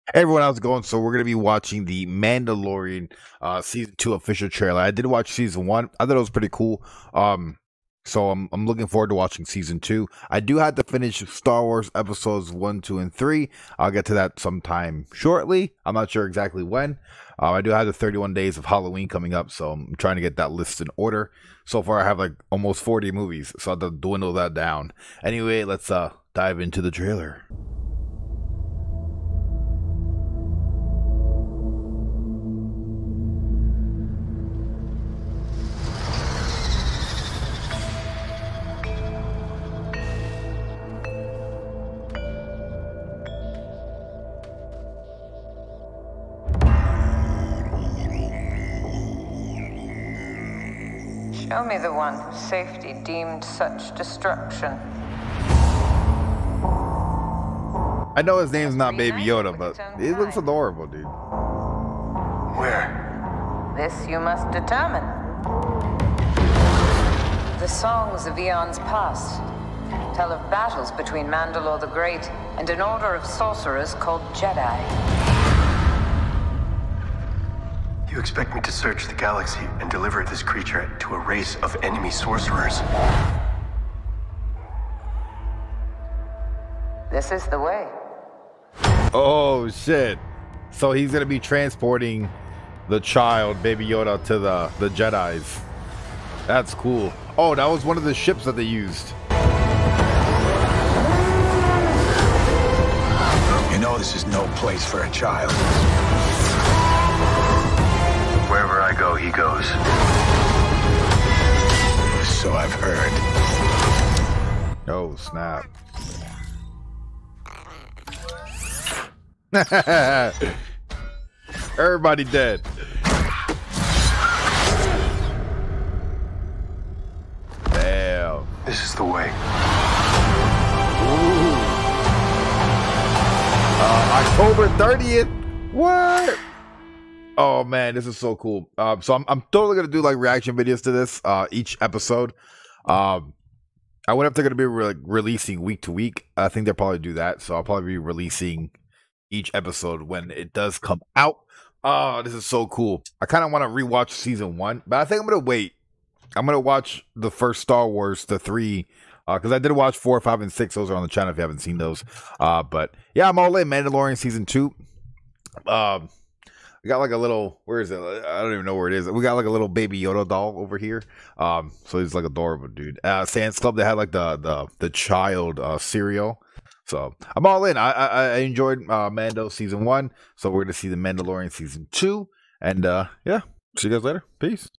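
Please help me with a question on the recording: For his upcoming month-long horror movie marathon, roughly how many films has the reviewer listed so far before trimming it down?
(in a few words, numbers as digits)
40.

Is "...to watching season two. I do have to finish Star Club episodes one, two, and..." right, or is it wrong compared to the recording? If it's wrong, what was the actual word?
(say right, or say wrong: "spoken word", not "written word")
wrong: "Wars", not "Club".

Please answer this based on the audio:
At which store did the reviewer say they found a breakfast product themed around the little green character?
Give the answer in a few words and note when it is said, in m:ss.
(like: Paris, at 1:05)
Sam's Club, at 2:53.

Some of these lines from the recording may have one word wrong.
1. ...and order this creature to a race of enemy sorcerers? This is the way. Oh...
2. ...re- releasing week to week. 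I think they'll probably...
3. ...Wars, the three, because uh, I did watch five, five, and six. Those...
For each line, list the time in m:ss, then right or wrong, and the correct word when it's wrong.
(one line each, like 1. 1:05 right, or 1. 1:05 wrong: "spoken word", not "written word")
1. 1:19 wrong: "deliver", not "order"
2. 2:24 right
3. 2:37 wrong: "four", not "five".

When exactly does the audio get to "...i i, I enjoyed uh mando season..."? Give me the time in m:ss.
2:57.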